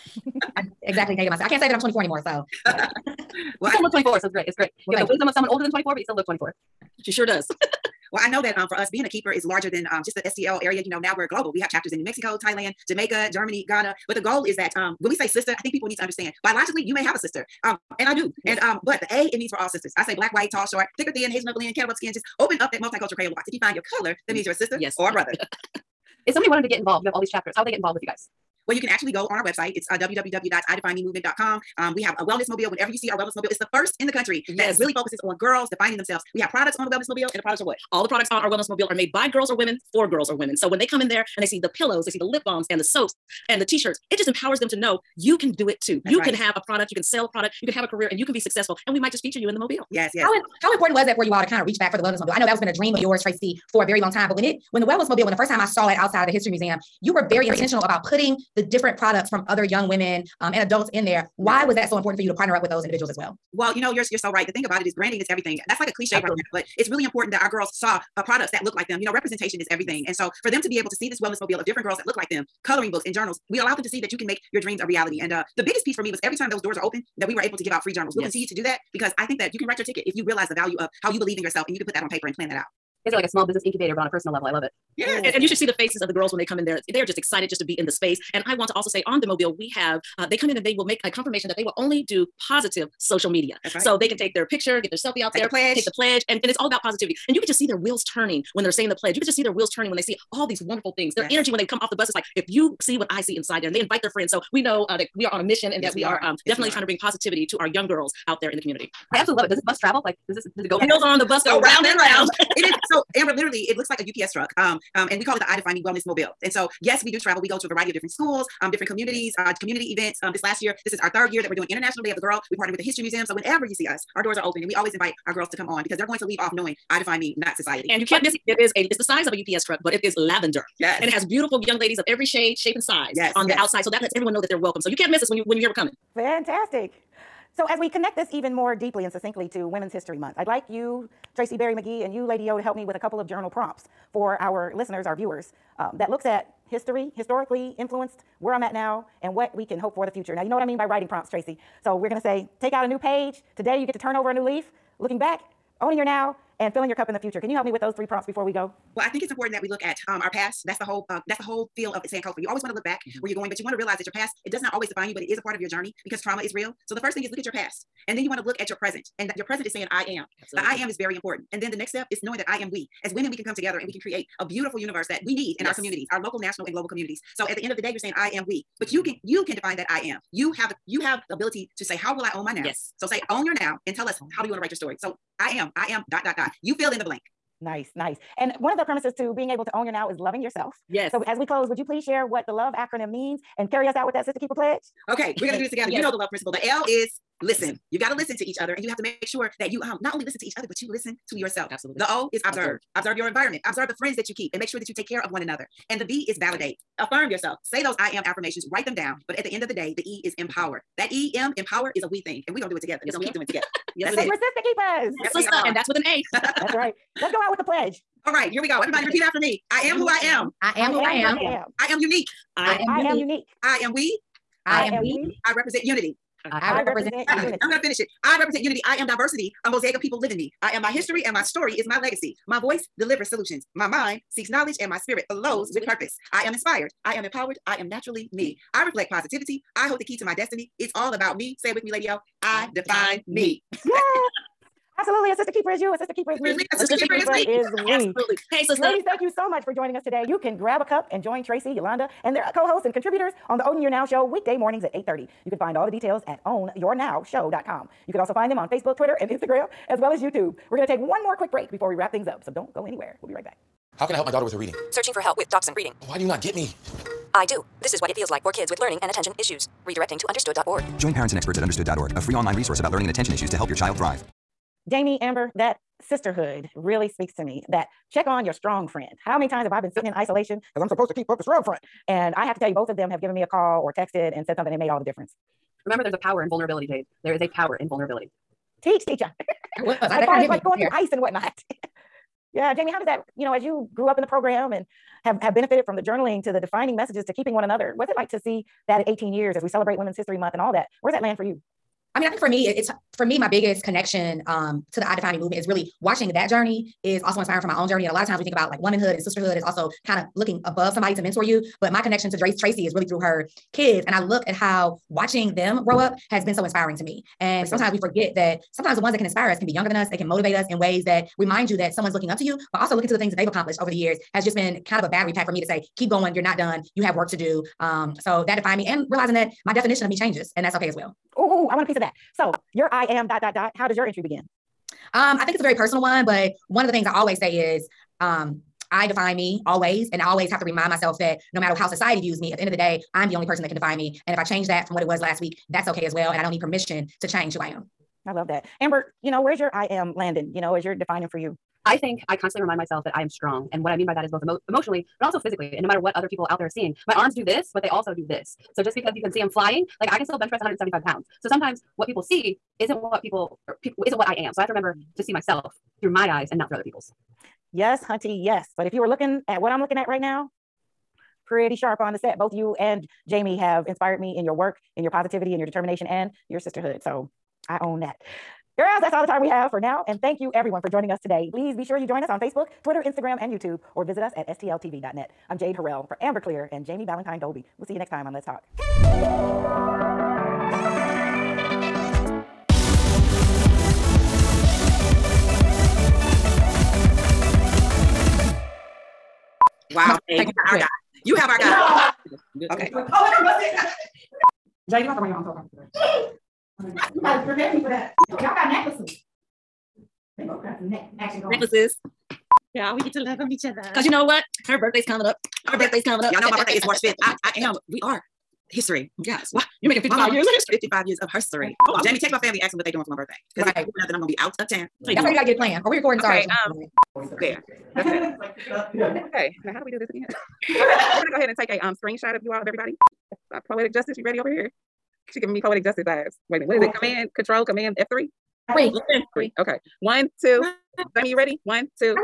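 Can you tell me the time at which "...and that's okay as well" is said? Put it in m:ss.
5:30.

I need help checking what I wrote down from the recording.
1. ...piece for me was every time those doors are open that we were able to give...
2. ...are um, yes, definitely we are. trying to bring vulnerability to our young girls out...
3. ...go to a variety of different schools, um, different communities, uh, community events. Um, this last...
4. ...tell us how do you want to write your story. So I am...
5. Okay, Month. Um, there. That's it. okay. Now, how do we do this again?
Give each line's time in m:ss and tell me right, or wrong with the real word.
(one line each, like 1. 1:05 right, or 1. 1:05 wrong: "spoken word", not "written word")
1. 1:15 right
2. 1:46 wrong: "positivity", not "vulnerability"
3. 1:57 right
4. 3:03 right
5. 7:06 wrong: "Sorry", not "Month".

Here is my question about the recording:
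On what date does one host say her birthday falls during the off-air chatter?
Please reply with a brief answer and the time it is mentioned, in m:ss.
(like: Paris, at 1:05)
March 5, at 6:56.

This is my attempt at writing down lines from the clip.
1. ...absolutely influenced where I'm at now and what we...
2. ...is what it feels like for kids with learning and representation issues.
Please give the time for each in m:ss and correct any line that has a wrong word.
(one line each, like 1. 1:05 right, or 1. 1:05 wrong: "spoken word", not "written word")
1. 2:27 wrong: "historically", not "absolutely"
2. 4:27 wrong: "attention", not "representation".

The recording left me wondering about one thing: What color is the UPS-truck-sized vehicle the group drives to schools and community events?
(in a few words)
Lavender.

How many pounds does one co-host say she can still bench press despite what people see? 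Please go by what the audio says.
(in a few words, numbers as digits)
175.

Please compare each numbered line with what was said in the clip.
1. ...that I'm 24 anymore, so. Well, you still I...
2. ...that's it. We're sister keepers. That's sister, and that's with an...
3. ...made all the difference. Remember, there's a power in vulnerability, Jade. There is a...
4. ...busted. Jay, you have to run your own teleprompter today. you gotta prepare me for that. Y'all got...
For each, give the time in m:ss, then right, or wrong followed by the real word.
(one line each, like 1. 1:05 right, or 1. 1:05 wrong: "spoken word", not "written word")
1. 0:01 right
2. 3:34 right
3. 4:44 right
4. 6:43 right.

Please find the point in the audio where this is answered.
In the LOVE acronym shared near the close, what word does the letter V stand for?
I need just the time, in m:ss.
3:26.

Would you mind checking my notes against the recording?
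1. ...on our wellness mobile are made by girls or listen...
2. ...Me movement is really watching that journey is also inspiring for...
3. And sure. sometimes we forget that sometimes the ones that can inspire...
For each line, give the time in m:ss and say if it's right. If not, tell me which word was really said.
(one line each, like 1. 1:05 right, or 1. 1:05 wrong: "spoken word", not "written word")
1. 0:38 wrong: "women", not "listen"
2. 5:05 right
3. 5:17 right.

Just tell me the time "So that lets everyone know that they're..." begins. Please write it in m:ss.
2:13.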